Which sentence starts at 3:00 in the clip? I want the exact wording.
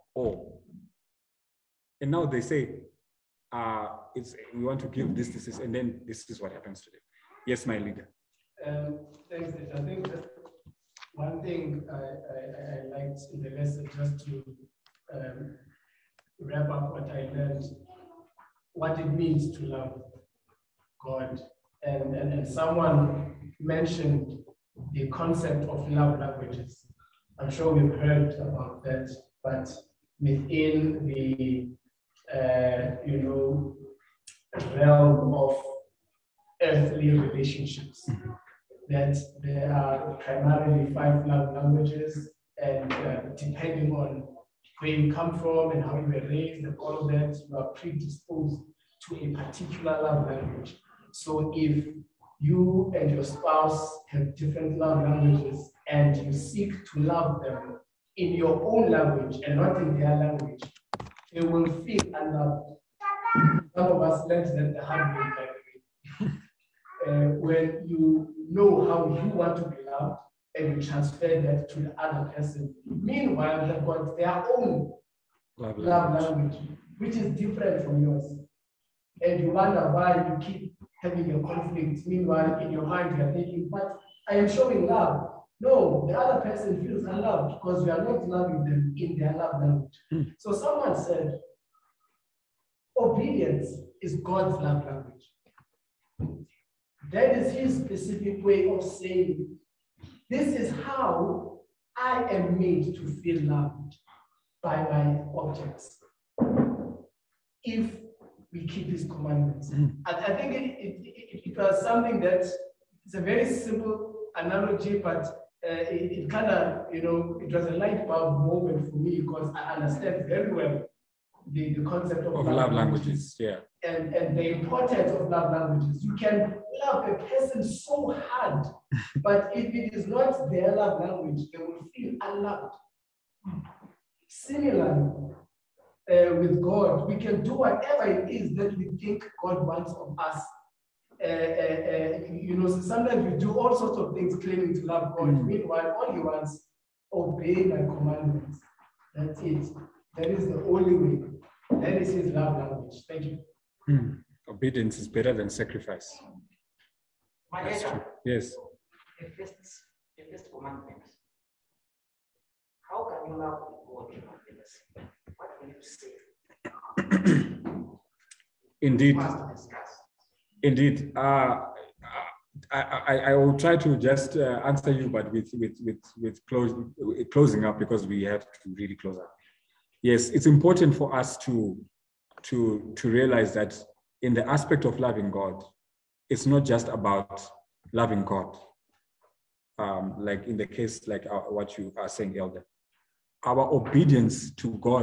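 Yes, it's important for us to to to realize that in the aspect of loving God, it's not just about loving God.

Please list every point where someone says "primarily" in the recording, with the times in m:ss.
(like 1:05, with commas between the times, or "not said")
0:40.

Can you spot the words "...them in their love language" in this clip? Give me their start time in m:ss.
1:28.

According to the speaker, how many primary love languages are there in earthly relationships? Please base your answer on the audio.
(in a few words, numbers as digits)
5.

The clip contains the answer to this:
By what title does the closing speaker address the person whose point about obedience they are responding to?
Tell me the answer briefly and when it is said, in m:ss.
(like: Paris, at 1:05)
Elder, at 3:12.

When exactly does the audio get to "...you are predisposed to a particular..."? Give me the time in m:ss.
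0:47.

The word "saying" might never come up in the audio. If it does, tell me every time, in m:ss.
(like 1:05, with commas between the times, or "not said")
1:38, 3:12.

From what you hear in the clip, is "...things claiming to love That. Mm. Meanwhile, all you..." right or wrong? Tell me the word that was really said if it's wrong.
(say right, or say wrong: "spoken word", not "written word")
wrong: "God", not "That".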